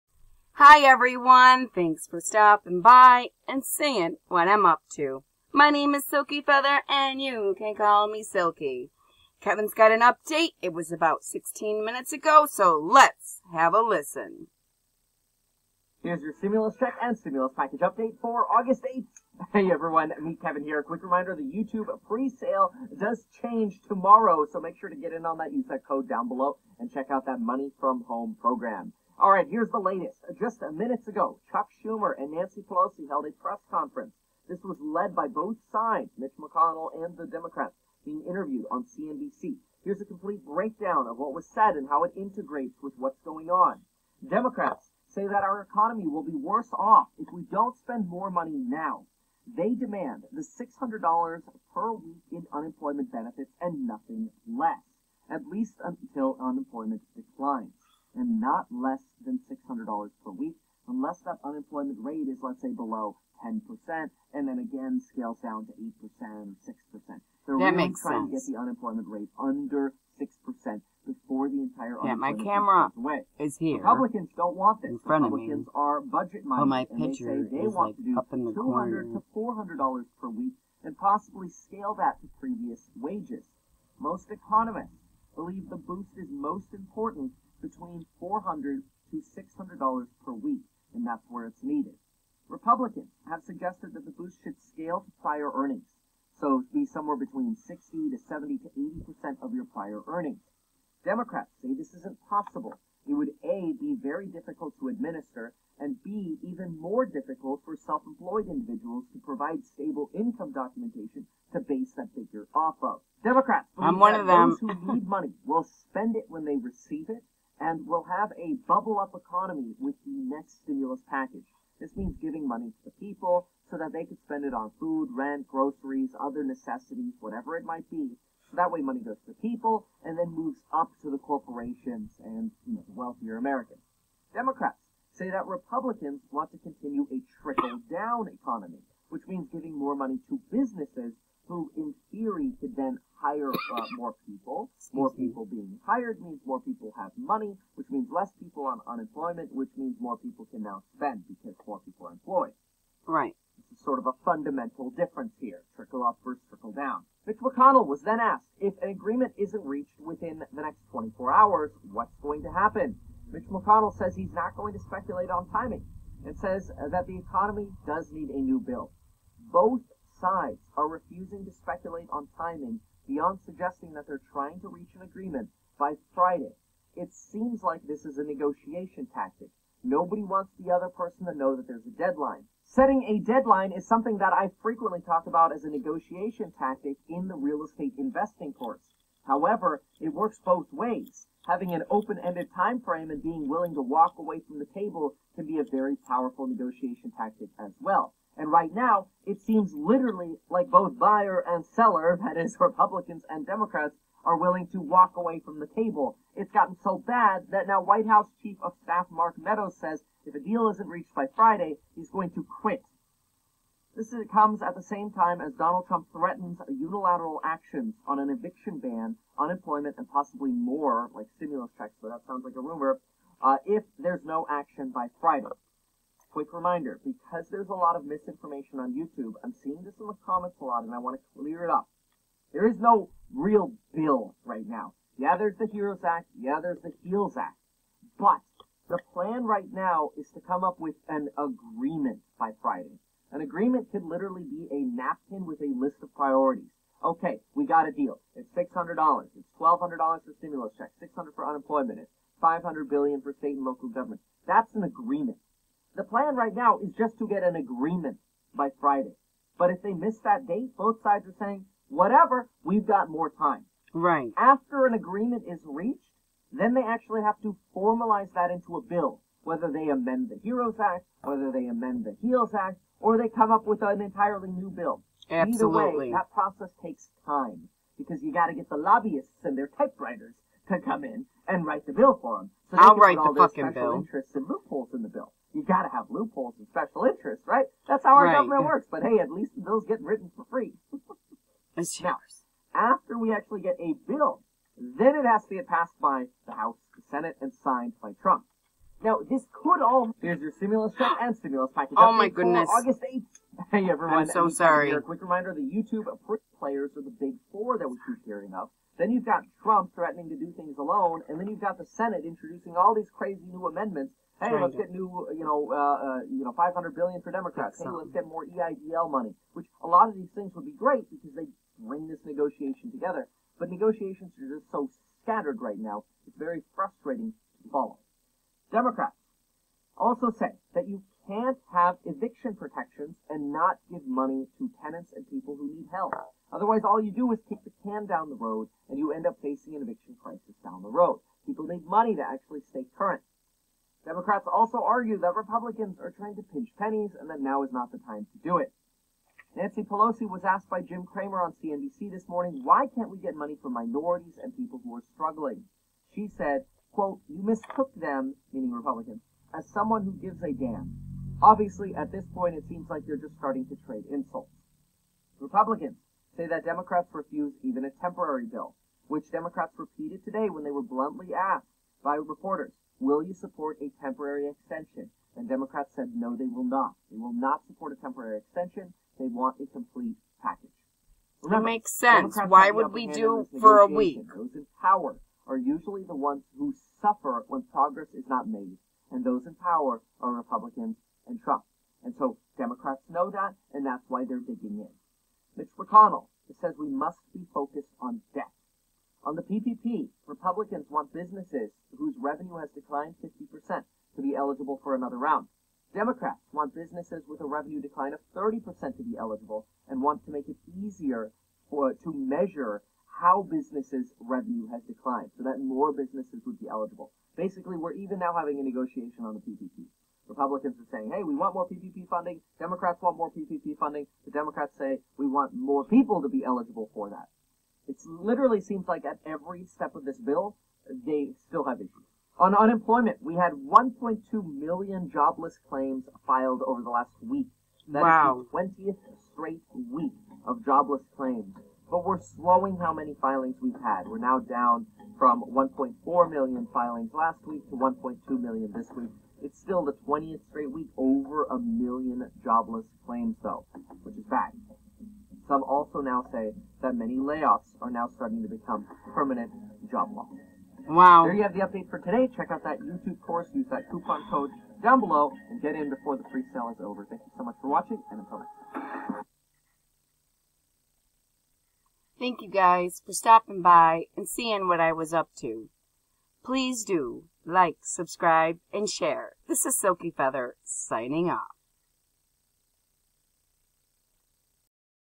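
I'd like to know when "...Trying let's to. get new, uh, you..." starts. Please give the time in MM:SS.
05:14.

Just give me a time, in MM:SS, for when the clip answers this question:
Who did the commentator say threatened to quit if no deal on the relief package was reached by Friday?
03:29.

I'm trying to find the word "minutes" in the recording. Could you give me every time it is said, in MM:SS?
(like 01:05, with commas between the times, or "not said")
00:11, 00:30.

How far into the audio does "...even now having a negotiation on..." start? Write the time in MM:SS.
06:57.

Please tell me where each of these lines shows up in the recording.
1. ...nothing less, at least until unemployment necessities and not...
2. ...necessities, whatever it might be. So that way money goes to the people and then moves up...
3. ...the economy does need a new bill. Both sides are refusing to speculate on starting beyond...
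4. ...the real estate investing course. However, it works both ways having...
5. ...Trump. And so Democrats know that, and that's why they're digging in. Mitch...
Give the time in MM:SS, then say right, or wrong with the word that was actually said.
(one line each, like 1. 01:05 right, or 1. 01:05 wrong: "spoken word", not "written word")
1. 00:53 wrong: "declines", not "necessities"
2. 02:06 right
3. 02:47 wrong: "timing", not "starting"
4. 03:07 right
5. 06:31 right.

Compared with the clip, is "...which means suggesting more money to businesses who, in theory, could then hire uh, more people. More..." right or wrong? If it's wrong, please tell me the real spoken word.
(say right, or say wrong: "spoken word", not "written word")
wrong: "giving", not "suggesting".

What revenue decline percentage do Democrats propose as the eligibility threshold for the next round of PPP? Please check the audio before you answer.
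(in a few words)
30%.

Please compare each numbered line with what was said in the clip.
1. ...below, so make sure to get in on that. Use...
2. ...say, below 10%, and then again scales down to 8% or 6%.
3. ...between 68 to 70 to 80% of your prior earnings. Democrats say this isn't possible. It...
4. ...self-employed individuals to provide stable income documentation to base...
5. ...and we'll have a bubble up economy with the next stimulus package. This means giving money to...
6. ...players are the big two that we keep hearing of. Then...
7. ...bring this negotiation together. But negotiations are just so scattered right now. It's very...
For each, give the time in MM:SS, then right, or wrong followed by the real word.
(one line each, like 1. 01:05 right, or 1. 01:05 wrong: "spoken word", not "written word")
1. 00:23 wrong: "tomorrow", not "below"
2. 01:02 right
3. 01:37 wrong: "60", not "68"
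4. 01:47 right
5. 01:57 right
6. 05:06 wrong: "four", not "two"
7. 05:21 right.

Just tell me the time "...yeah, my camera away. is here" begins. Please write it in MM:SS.
01:12.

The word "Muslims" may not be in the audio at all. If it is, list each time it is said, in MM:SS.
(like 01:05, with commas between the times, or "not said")
not said.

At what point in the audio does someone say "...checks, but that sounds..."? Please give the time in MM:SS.
03:41.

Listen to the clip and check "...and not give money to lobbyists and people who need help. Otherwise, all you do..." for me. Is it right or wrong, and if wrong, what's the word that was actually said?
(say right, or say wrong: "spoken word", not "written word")
wrong: "tenants", not "lobbyists".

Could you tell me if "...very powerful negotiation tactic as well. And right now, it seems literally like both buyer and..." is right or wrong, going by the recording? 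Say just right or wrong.
right.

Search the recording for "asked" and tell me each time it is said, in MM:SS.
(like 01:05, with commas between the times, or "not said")
02:38, 05:50, 06:11.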